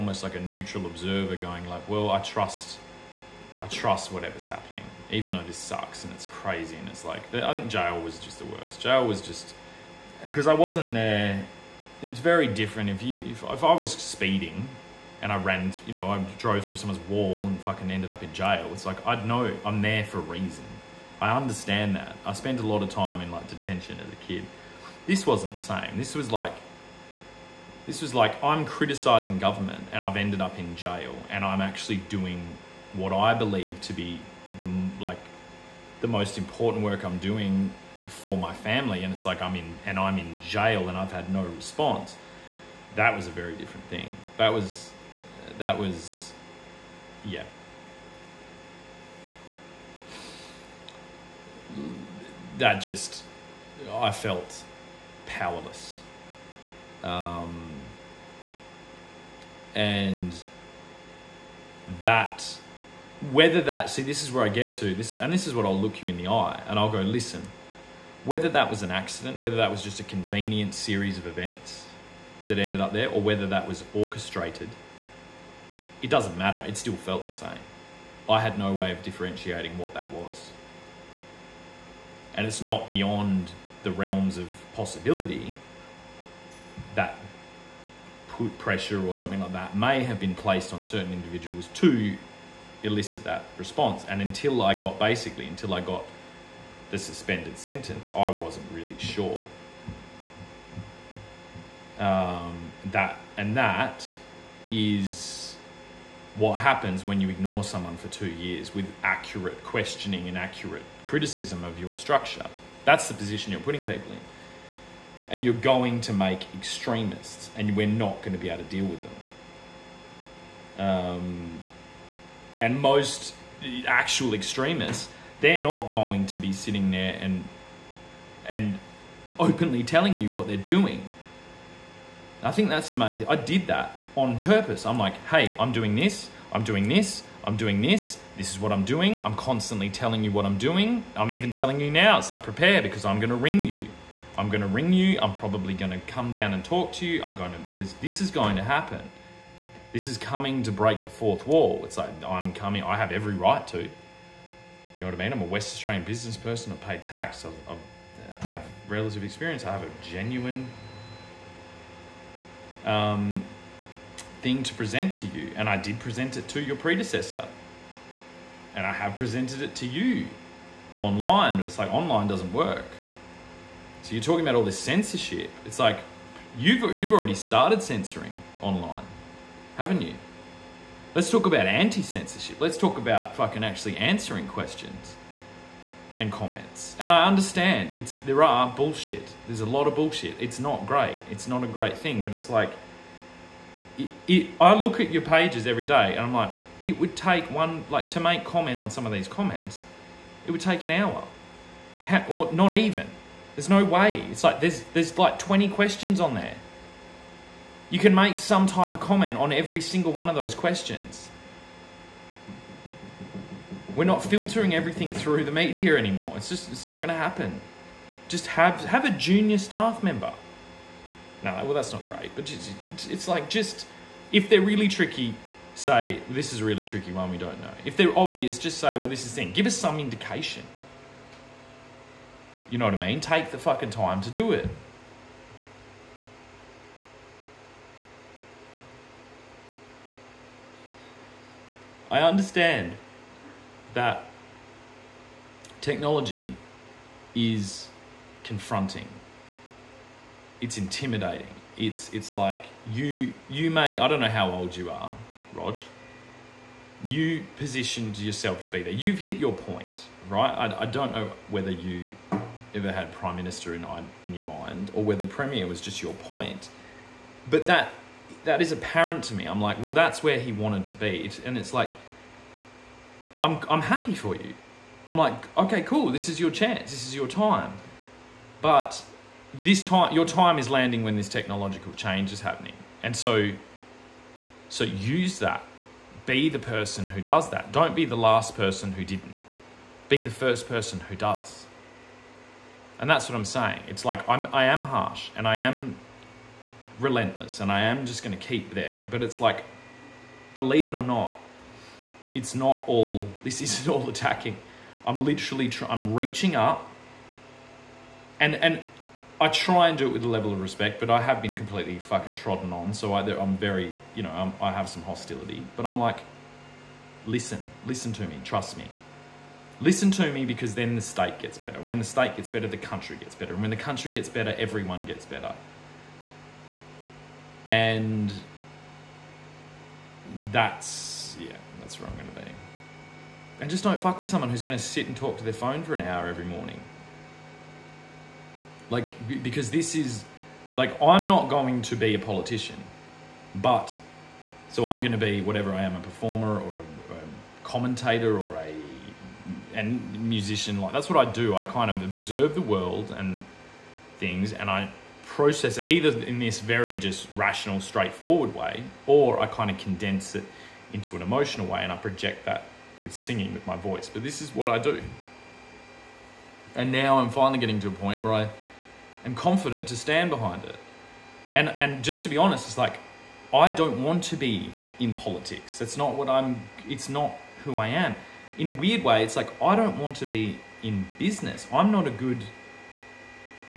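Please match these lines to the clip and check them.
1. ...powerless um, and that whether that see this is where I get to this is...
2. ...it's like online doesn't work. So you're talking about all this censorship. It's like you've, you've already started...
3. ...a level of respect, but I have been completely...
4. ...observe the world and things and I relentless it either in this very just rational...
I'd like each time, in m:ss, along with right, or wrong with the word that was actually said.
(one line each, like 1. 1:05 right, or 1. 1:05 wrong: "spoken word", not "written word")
1. 0:55 right
2. 2:51 right
3. 5:10 right
4. 5:52 wrong: "process", not "relentless".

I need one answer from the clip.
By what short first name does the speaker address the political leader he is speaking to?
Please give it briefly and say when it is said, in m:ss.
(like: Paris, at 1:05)
Rog, at 4:15.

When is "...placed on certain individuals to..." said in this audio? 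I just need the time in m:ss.
1:30.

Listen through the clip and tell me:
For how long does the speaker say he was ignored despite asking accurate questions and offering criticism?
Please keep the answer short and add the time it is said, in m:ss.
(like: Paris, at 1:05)
2 years, at 1:48.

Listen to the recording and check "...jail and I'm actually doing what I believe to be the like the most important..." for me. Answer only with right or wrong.
right.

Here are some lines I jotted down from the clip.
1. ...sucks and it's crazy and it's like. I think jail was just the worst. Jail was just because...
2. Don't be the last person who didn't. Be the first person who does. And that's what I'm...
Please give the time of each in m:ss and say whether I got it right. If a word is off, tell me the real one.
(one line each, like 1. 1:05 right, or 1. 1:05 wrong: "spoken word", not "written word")
1. 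0:05 right
2. 4:47 right.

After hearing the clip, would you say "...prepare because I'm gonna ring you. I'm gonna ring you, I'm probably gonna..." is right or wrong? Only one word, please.
right.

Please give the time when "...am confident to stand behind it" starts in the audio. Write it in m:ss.
6:09.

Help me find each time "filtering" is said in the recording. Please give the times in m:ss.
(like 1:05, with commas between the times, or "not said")
3:34.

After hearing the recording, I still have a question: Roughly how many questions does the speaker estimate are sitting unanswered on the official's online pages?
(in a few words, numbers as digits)
20.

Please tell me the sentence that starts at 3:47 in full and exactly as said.
If they're obvious, just say well this is the thing.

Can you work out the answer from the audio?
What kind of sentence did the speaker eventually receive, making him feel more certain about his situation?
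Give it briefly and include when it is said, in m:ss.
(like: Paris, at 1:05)
Suspended sentence, at 1:36.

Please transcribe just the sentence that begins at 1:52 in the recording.
That's the position you're putting people in.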